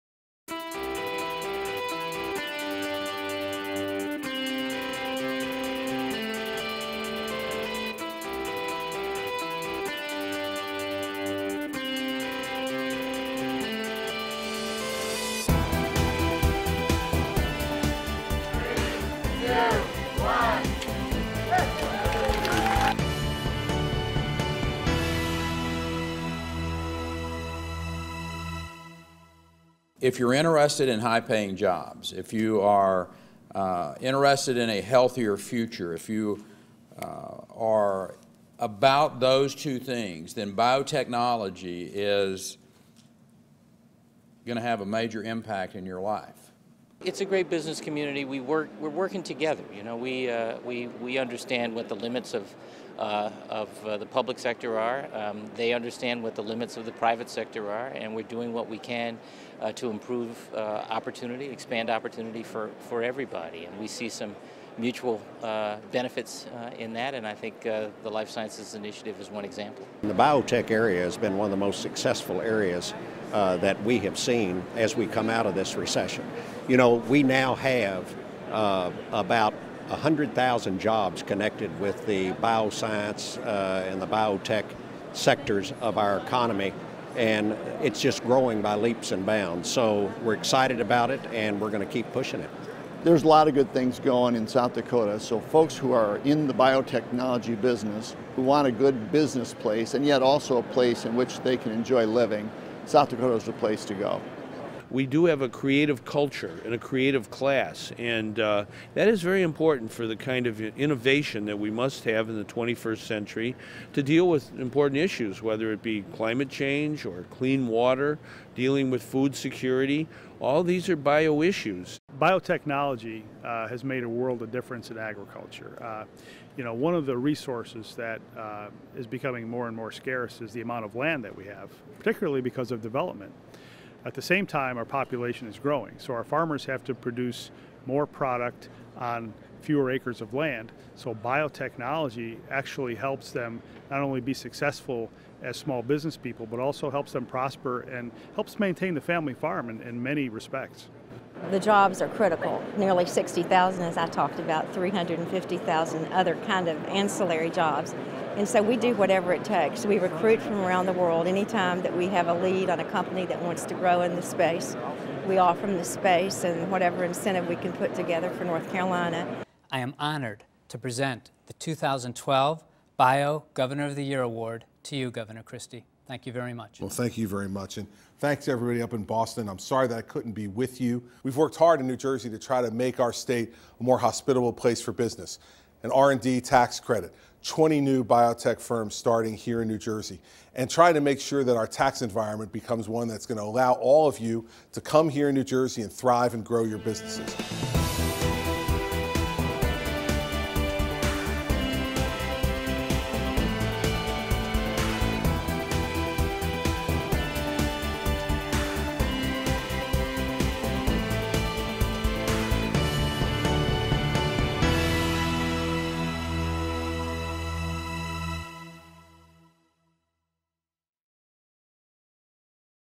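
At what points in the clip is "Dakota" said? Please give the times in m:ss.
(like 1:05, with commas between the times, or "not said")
1:34, 1:43.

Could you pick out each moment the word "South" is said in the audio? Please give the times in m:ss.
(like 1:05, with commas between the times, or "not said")
1:34, 1:42.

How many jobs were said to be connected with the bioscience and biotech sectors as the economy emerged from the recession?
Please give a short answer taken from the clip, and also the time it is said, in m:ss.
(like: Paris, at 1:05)
100,000, at 1:19.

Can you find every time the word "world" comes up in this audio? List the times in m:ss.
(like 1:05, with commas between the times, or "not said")
2:04, 2:40.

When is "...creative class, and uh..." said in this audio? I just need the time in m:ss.
1:46.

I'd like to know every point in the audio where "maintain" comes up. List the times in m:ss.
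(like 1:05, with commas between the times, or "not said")
2:28.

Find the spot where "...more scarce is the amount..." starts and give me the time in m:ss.
2:09.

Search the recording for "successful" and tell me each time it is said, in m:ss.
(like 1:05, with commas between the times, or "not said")
1:11, 2:24.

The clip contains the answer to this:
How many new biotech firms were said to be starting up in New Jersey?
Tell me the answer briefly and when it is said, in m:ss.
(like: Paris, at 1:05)
20, at 3:07.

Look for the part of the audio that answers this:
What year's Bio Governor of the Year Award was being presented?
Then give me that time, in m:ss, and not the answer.
2:51.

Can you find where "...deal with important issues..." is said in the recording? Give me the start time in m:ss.
1:54.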